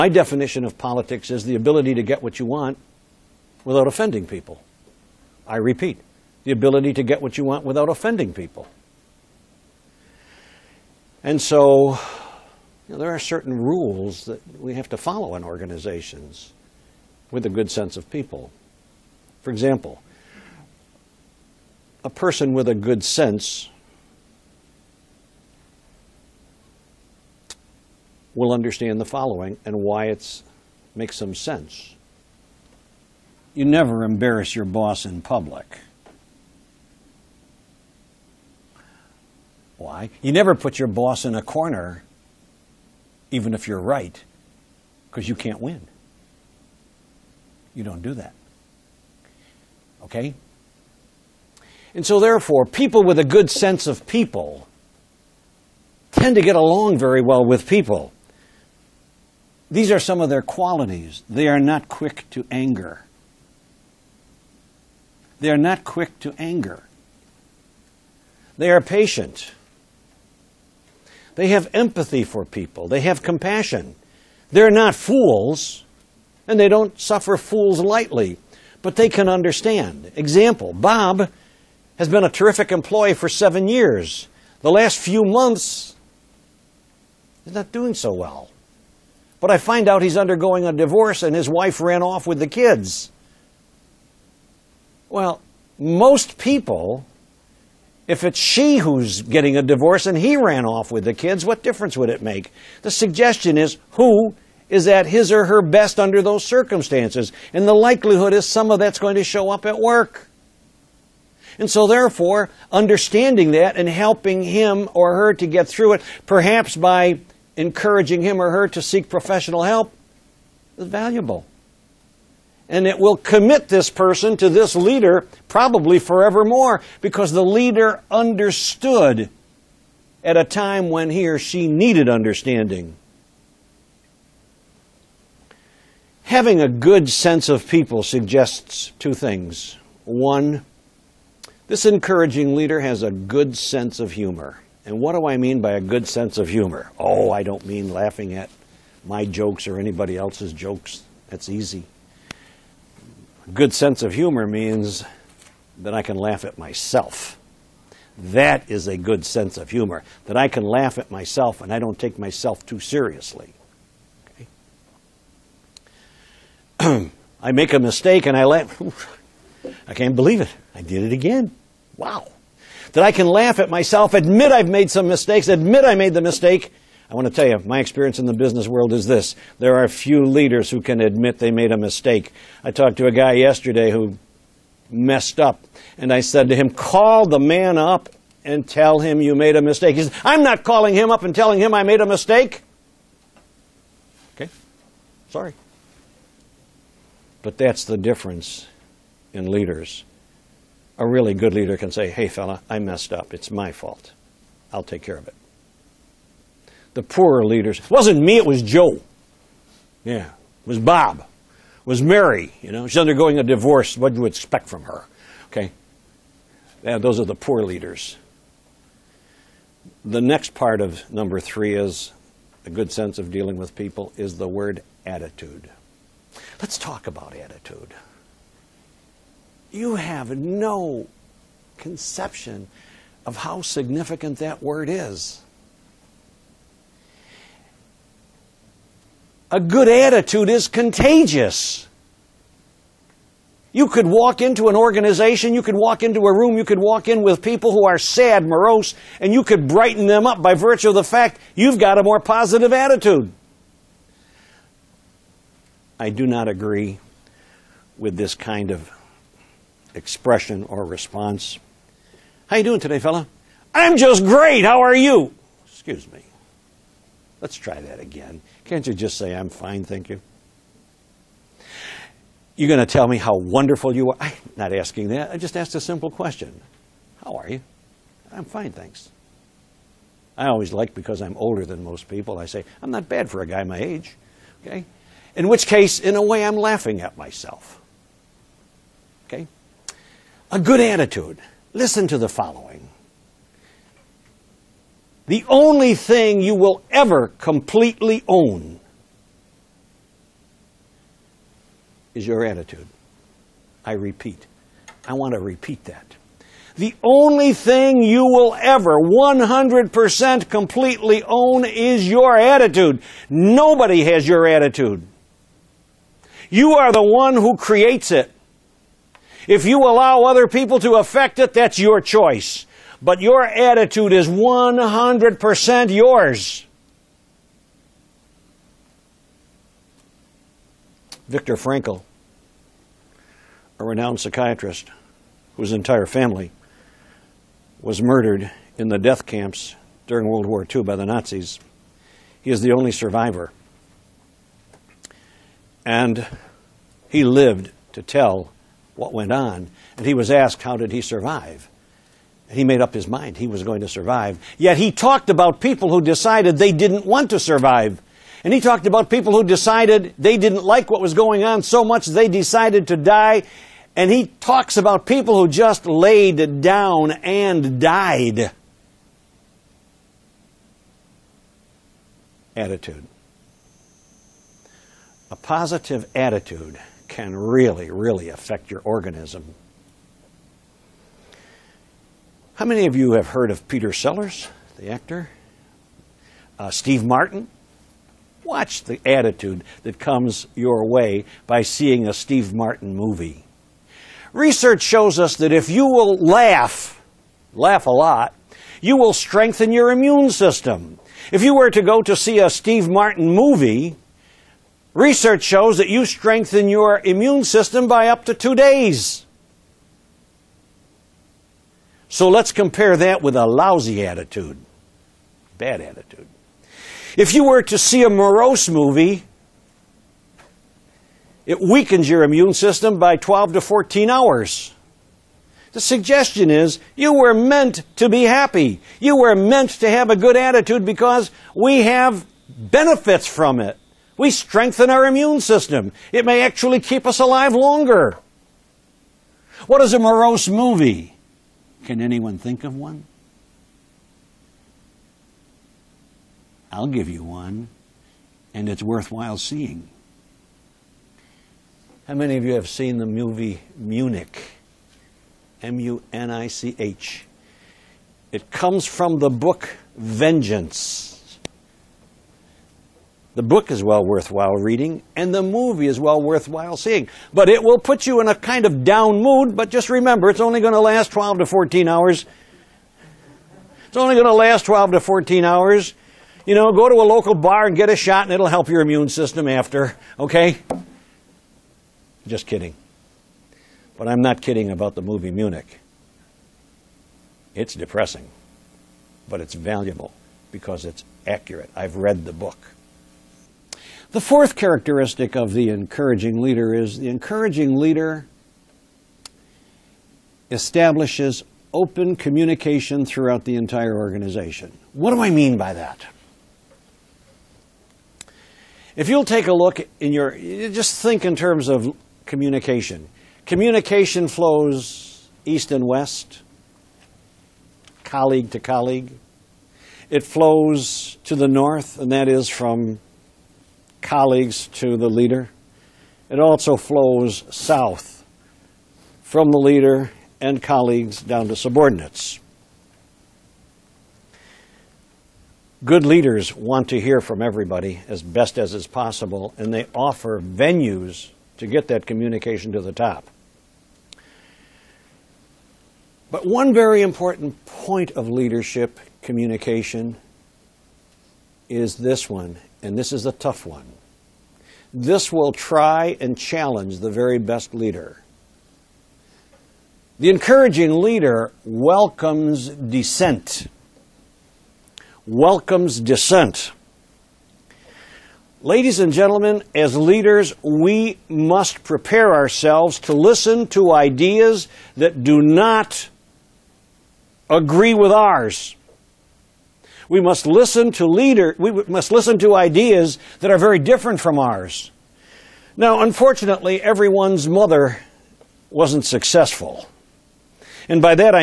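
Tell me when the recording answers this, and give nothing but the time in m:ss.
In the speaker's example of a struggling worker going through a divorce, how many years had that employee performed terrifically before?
1:23.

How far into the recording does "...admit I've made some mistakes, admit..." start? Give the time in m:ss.
2:54.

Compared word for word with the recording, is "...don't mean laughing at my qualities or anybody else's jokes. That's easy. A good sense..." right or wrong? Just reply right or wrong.
wrong.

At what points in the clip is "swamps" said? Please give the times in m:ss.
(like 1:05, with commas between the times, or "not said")
not said.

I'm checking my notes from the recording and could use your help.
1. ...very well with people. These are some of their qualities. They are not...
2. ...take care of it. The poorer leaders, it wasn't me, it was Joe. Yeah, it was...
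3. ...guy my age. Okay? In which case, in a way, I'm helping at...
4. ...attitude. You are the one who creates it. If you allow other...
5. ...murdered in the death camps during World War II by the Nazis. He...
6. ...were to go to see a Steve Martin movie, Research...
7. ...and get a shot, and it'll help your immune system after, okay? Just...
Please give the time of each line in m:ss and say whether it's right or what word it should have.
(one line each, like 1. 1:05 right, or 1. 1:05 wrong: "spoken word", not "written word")
1. 0:56 right
2. 3:24 right
3. 4:43 wrong: "laughing", not "helping"
4. 5:14 right
5. 5:38 right
6. 6:41 right
7. 7:57 right.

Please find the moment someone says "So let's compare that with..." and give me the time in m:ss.
6:52.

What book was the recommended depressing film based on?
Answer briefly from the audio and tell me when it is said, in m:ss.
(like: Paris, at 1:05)
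Vengeance, at 7:39.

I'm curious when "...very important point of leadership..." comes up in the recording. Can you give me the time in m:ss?
9:06.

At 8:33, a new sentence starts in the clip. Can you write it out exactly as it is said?
Communication flows east and west, colleague to colleague.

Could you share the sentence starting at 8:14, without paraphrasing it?
The fourth characteristic of the encouraging leader is the encouraging leader establishes open communication throughout the entire organization.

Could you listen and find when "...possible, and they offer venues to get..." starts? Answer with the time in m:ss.
8:58.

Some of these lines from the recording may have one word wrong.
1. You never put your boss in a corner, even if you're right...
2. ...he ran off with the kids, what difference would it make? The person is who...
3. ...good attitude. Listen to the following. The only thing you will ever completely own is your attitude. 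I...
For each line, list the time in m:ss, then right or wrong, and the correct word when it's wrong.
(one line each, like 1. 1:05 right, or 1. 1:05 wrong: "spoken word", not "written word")
1. 0:40 right
2. 1:40 wrong: "suggestion", not "person"
3. 4:50 right.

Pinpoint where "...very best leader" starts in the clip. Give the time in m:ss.
9:17.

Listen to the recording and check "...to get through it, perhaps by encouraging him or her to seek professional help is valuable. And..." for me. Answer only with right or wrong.
right.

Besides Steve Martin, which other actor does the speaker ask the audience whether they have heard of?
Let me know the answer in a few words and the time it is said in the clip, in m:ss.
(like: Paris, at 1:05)
Peter Sellers, at 6:23.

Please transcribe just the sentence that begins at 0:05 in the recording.
I repeat, the ability to get what you want without offending people.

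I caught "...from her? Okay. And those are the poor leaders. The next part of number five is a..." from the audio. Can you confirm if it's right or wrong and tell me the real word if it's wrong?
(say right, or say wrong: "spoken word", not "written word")
wrong: "three", not "five".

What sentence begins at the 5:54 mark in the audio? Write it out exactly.
Yet he talked about people who decided they didn't want to survive.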